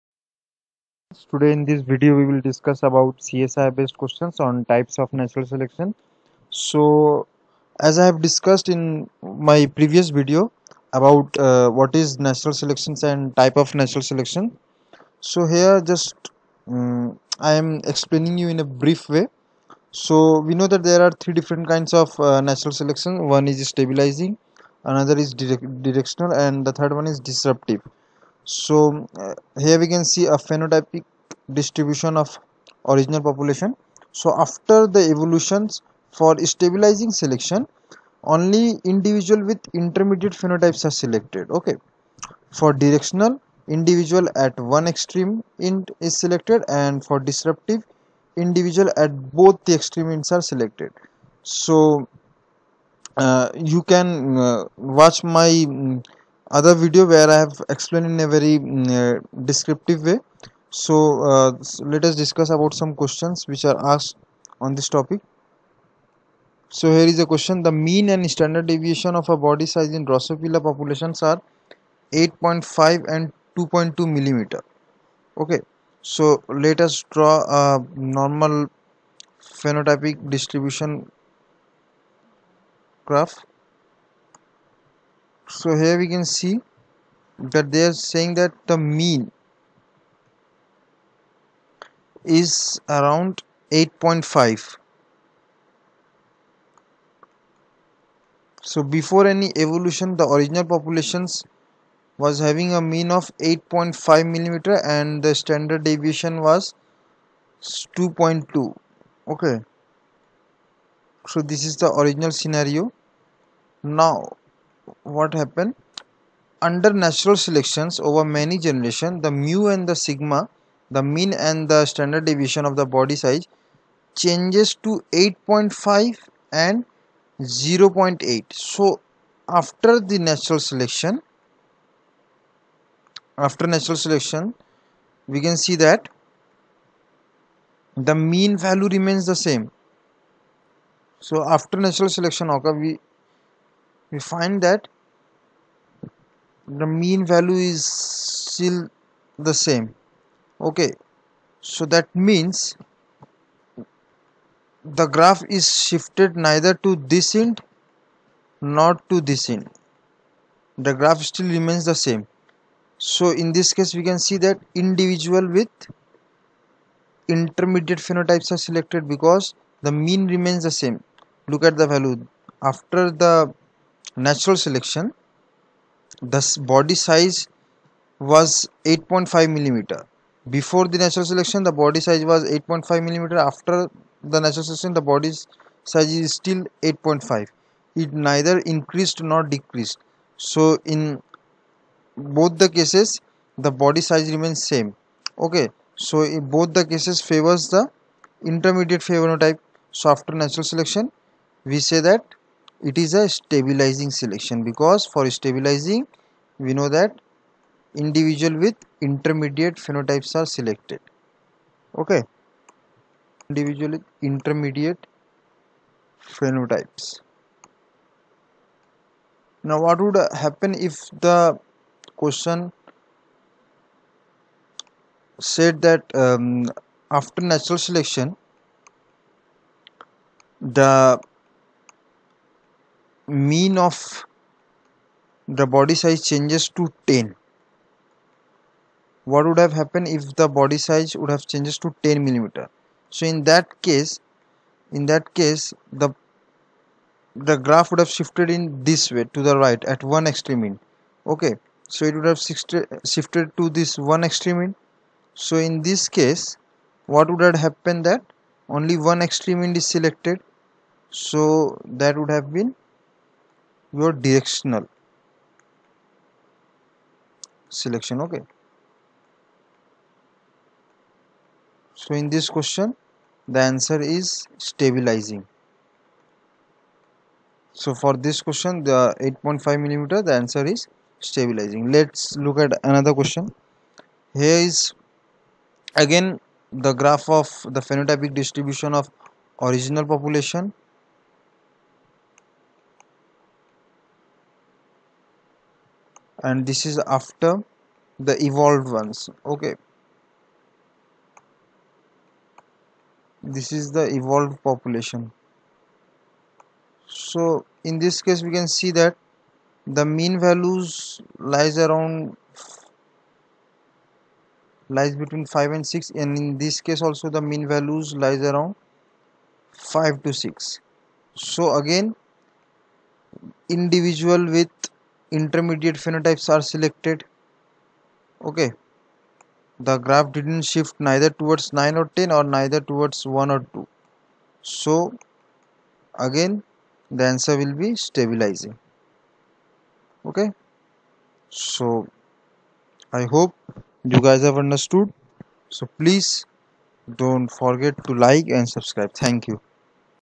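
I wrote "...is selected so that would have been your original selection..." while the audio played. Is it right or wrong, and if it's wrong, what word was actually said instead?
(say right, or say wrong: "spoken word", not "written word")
wrong: "directional", not "original".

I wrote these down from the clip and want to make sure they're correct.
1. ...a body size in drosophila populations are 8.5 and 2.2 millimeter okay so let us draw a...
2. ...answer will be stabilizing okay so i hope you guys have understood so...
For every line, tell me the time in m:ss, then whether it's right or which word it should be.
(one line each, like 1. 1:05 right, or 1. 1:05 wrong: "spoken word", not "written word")
1. 1:09 right
2. 5:37 right.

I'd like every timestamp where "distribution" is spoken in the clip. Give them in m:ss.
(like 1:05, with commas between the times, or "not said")
0:31, 1:20, 4:48.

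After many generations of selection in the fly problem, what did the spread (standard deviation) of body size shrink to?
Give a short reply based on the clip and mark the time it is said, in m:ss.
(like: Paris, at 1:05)
0.8, at 2:07.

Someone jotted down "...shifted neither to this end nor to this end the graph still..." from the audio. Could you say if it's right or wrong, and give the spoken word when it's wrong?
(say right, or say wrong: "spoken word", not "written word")
right.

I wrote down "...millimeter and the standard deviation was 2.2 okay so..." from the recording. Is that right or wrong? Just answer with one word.
right.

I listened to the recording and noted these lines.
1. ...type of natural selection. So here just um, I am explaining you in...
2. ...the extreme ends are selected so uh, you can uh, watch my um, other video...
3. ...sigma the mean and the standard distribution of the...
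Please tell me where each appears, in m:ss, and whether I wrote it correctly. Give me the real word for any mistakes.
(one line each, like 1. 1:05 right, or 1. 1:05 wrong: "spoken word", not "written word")
1. 0:13 right
2. 0:49 right
3. 1:59 wrong: "deviation", not "distribution".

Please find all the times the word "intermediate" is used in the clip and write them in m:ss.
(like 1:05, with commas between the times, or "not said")
0:39, 2:47, 3:18, 3:29, 3:34, 5:25.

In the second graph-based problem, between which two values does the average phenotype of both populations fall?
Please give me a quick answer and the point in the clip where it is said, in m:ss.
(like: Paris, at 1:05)
5 and 6, at 5:15.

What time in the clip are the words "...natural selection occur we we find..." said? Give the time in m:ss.
2:21.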